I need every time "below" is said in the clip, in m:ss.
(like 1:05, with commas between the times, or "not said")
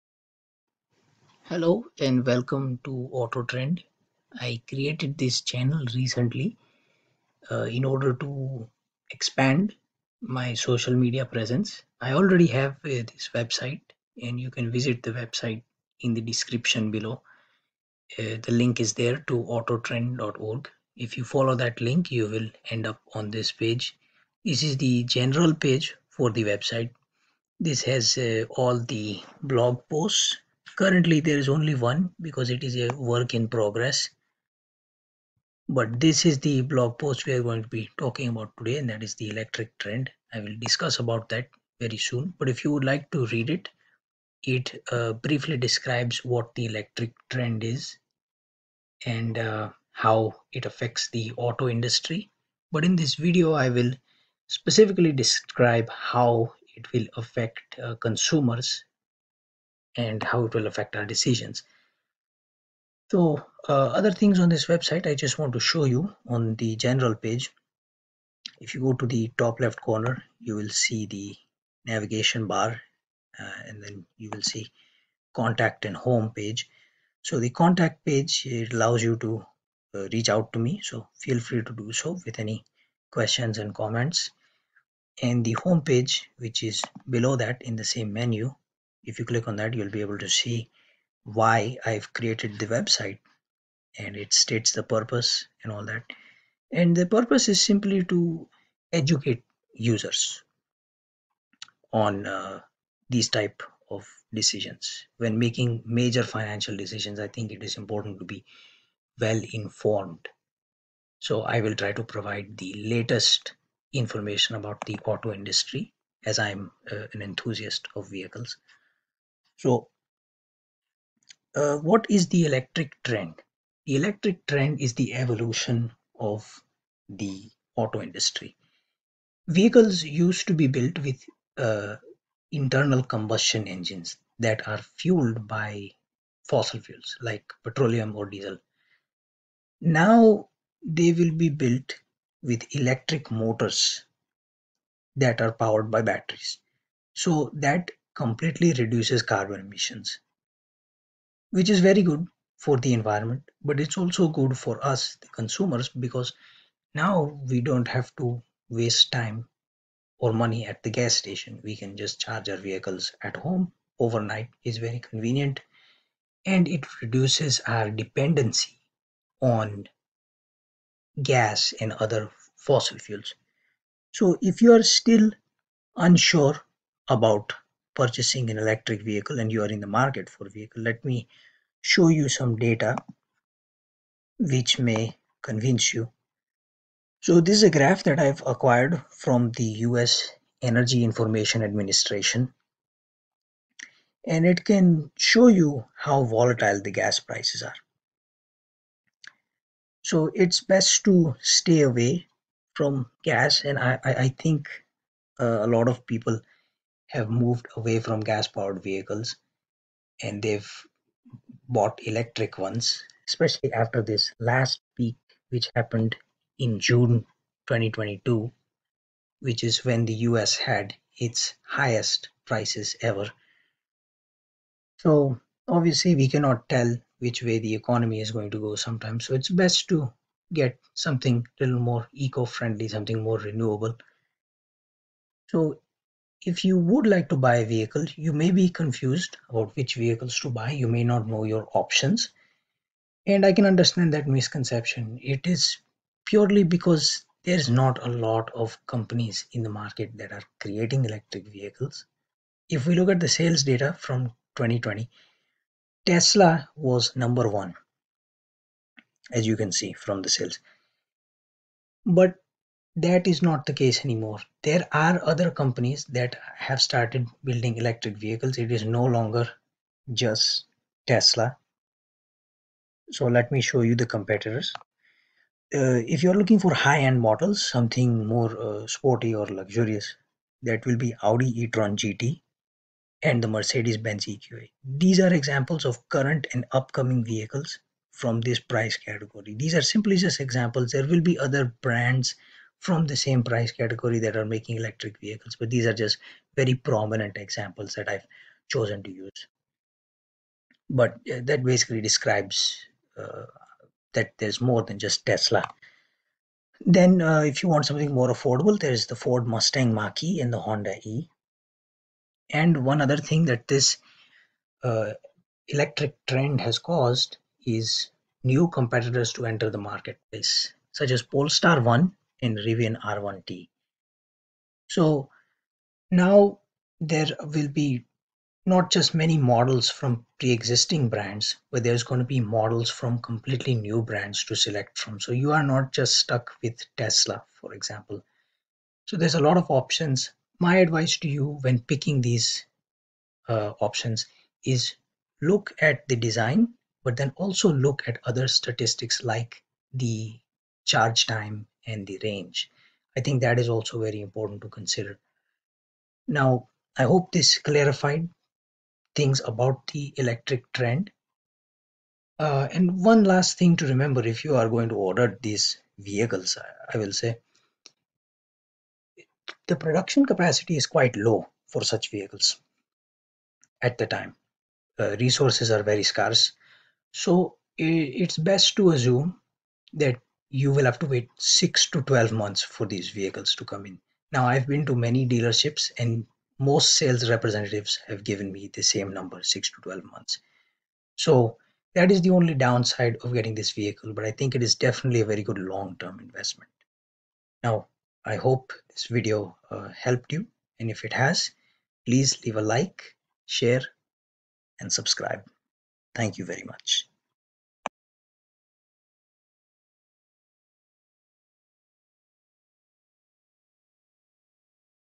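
0:16, 1:27.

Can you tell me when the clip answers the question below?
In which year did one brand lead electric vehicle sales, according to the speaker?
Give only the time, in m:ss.
4:14.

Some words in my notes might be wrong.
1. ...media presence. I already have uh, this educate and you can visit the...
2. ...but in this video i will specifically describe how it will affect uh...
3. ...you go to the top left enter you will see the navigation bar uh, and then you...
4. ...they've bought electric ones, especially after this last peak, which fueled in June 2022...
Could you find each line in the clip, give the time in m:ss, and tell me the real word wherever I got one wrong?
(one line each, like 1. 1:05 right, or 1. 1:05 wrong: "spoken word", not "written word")
1. 0:10 wrong: "website", not "educate"
2. 0:52 right
3. 1:08 wrong: "corner", not "enter"
4. 3:30 wrong: "happened", not "fueled".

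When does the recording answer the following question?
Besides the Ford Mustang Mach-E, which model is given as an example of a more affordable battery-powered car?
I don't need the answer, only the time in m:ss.
5:10.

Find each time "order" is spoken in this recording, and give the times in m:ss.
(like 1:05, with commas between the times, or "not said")
0:07, 6:04.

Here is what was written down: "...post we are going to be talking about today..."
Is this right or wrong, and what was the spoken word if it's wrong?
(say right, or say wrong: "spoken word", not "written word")
right.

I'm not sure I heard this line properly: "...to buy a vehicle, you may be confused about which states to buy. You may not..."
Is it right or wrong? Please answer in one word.
wrong.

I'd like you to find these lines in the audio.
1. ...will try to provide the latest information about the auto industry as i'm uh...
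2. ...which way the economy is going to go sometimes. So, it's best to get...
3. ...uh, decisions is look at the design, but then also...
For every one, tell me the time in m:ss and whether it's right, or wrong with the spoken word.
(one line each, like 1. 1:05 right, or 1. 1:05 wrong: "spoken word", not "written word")
1. 1:51 right
2. 3:47 right
3. 5:43 wrong: "options", not "decisions".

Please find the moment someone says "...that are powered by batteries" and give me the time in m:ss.
2:25.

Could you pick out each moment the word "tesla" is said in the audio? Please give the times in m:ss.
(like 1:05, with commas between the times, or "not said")
4:16, 4:31, 5:05, 5:36.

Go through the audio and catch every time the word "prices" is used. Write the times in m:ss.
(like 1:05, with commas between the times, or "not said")
3:17, 3:42, 4:48, 4:53.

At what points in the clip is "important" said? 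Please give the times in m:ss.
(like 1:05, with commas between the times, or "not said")
1:47, 5:54.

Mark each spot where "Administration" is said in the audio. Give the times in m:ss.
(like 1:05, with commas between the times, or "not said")
3:11.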